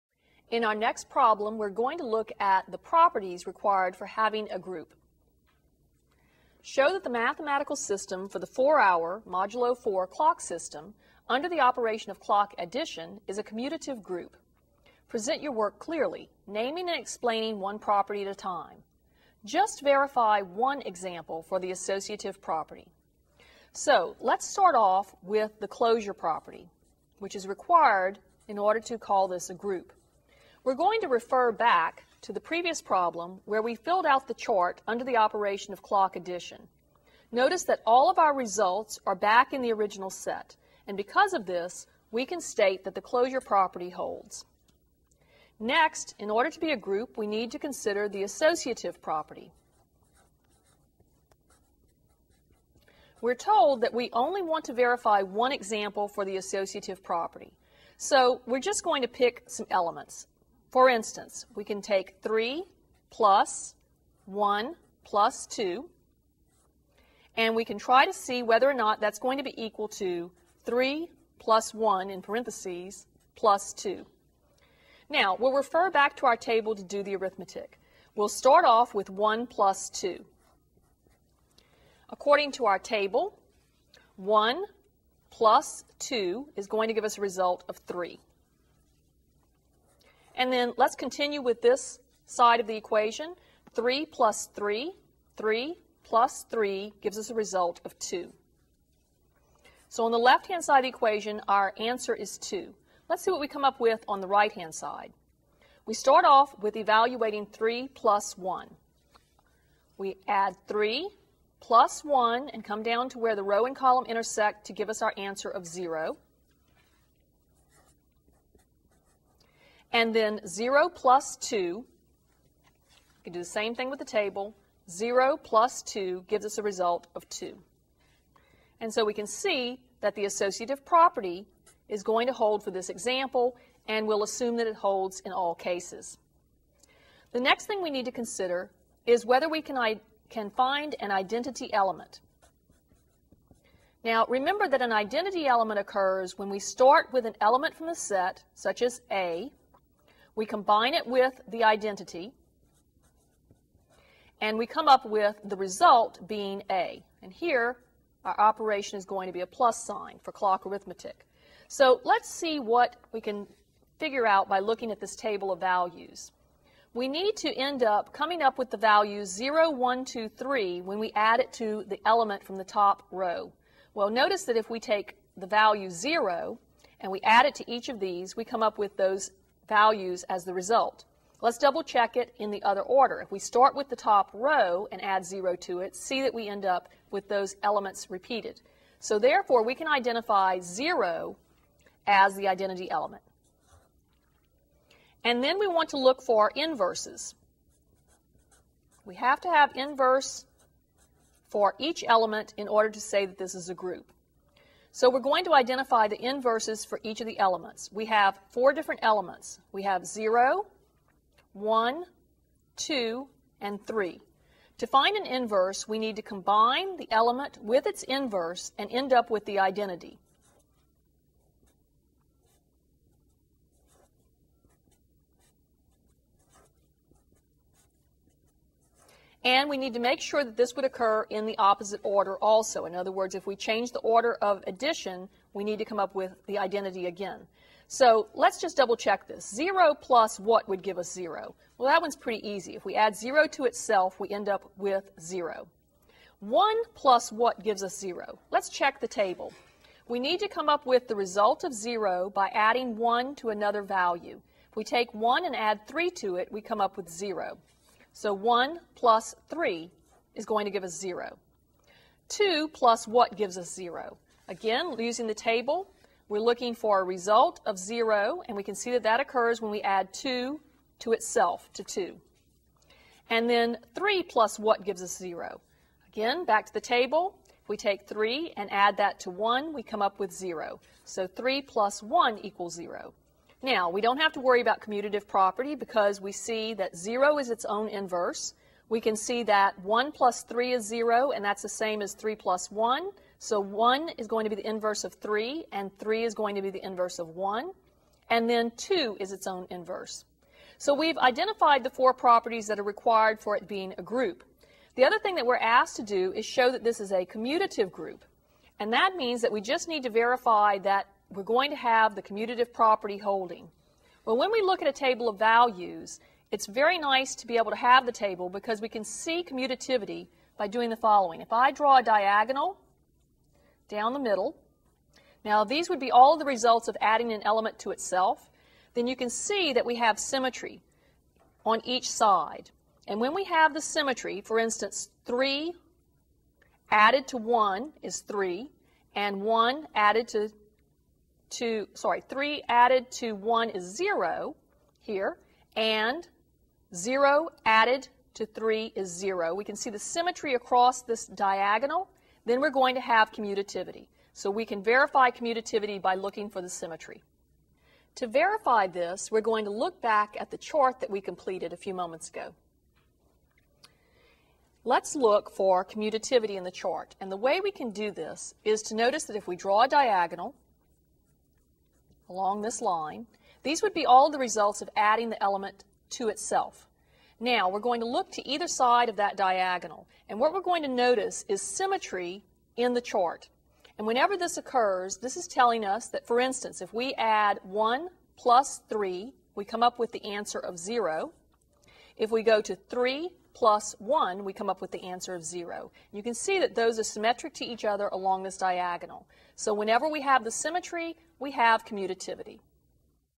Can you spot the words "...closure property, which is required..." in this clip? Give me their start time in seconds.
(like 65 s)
25 s.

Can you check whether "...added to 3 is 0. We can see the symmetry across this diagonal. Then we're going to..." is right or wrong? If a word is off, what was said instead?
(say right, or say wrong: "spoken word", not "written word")
right.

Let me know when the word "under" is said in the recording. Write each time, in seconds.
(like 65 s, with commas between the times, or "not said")
11 s, 34 s.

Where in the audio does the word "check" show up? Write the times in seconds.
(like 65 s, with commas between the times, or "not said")
181 s, 238 s, 248 s.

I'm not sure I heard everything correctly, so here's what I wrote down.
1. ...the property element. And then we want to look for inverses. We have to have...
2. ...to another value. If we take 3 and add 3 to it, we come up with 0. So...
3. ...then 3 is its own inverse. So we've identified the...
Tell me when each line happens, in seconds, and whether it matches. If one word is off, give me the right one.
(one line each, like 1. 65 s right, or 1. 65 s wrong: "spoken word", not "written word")
1. 192 s wrong: "identity", not "property"
2. 253 s wrong: "1", not "3"
3. 298 s wrong: "2", not "3".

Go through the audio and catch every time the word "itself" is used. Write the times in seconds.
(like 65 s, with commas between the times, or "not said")
243 s, 271 s, 327 s, 376 s.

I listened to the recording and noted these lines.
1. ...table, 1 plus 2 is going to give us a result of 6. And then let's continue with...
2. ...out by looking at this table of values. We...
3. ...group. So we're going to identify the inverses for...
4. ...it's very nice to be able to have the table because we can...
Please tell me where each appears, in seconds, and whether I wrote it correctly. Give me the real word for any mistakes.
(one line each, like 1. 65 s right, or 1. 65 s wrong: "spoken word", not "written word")
1. 82 s wrong: "3", not "6"
2. 164 s right
3. 203 s right
4. 316 s right.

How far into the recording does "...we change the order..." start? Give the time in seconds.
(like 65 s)
233 s.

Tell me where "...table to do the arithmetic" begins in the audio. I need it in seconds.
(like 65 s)
76 s.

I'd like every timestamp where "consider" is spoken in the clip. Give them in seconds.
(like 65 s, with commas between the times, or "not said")
47 s, 138 s.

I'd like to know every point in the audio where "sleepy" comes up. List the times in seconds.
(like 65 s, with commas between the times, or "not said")
not said.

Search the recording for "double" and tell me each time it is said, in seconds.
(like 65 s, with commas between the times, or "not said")
181 s, 238 s.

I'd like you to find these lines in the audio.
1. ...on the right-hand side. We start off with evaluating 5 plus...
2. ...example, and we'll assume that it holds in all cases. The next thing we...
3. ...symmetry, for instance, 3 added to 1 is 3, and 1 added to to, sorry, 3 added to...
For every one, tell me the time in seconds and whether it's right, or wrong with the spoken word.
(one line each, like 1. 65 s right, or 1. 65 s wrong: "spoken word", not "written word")
1. 104 s wrong: "3", not "5"
2. 132 s right
3. 333 s right.